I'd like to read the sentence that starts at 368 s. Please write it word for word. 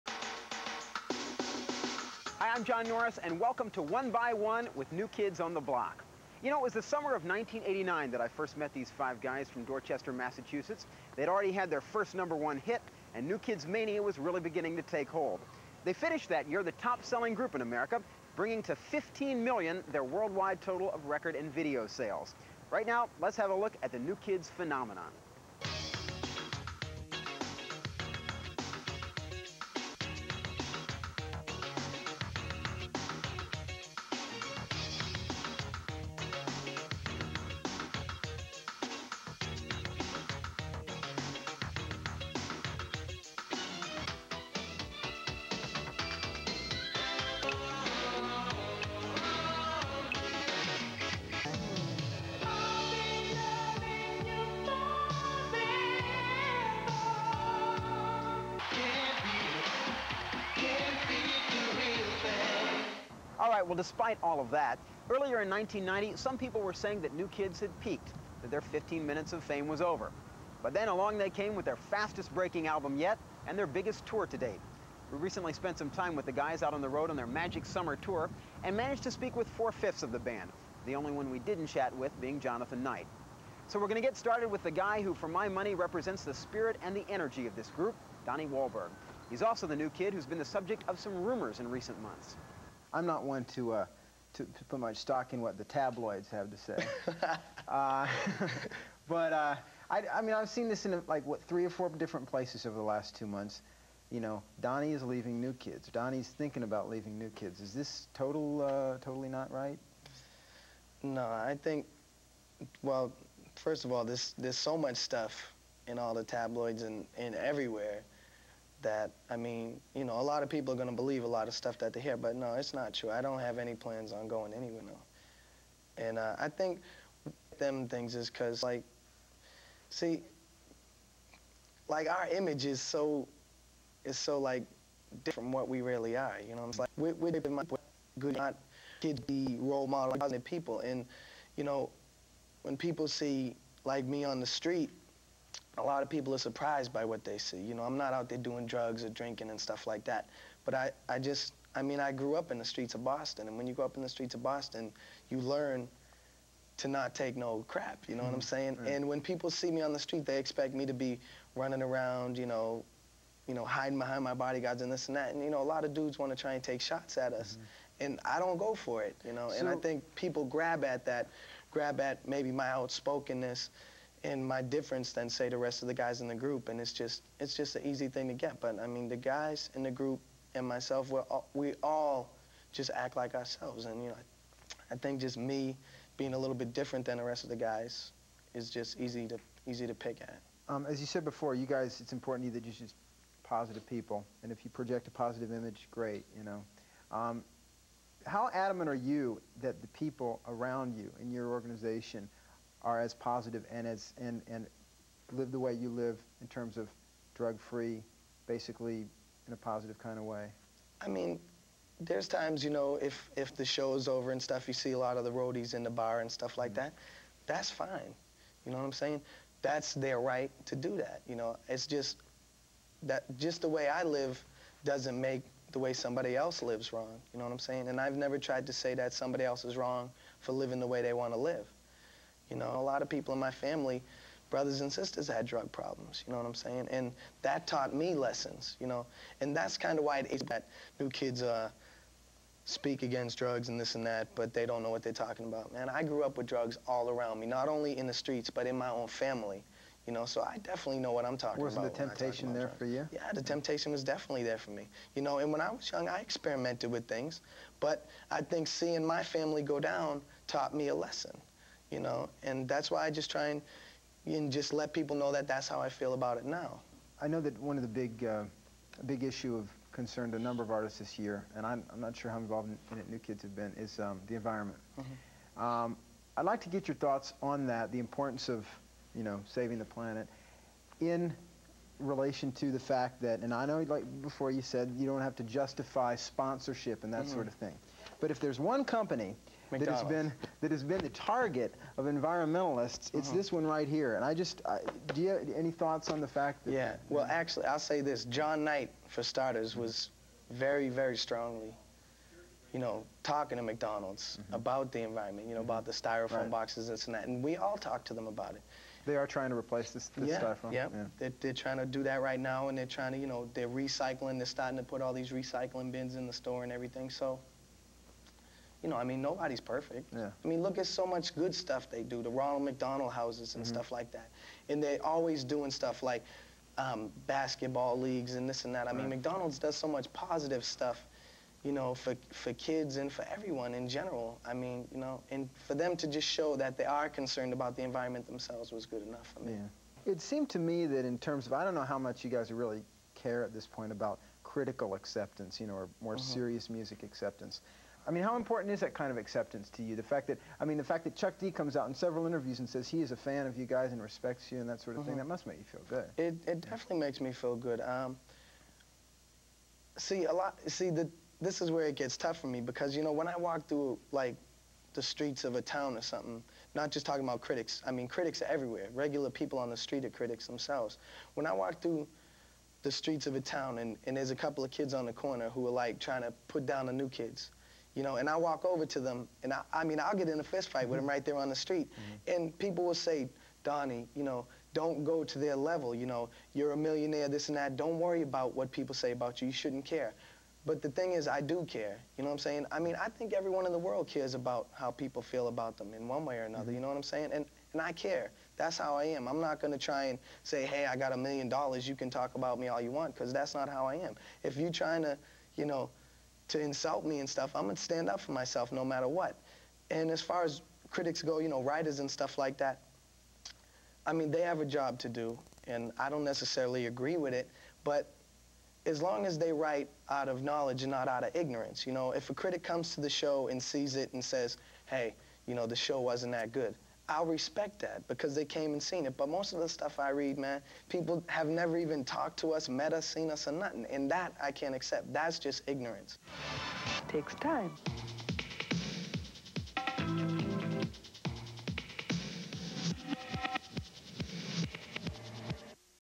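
Regular people on the street are critics themselves.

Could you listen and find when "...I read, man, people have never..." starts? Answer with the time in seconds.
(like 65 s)
429 s.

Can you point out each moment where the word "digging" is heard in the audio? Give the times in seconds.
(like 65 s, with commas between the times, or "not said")
not said.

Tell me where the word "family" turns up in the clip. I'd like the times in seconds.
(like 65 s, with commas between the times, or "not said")
233 s, 249 s, 259 s.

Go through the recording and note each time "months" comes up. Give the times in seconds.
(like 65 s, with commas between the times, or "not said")
92 s, 103 s.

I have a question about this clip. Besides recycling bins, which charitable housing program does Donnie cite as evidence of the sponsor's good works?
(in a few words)
Ronald McDonald houses.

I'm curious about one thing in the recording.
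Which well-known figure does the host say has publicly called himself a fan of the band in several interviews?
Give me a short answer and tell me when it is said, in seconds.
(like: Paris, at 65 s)
Chuck D, at 351 s.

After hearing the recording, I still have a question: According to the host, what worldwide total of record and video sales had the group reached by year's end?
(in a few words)
15 million.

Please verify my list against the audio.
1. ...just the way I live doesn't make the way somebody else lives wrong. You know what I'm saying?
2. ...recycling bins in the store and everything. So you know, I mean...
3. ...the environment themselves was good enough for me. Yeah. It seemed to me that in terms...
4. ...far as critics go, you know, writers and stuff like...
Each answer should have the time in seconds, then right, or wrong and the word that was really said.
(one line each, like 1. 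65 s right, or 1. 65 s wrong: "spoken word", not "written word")
1. 223 s right
2. 315 s right
3. 337 s right
4. 410 s right.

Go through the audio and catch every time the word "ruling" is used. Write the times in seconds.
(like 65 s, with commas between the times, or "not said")
not said.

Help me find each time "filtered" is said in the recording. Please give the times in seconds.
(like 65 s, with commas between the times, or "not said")
not said.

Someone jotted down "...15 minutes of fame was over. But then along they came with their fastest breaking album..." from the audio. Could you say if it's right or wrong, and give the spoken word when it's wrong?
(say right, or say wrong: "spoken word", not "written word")
right.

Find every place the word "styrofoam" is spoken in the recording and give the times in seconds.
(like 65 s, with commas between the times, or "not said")
305 s, 310 s.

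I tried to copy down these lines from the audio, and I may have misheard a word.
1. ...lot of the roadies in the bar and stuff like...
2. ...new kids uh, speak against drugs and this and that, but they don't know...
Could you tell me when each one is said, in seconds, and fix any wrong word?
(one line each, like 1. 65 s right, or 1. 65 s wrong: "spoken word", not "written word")
1. 214 s right
2. 240 s right.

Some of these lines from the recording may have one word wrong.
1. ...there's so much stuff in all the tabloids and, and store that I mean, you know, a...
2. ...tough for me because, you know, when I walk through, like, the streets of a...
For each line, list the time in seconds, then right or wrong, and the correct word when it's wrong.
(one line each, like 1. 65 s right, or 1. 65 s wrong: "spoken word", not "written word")
1. 114 s wrong: "everywhere", not "store"
2. 362 s right.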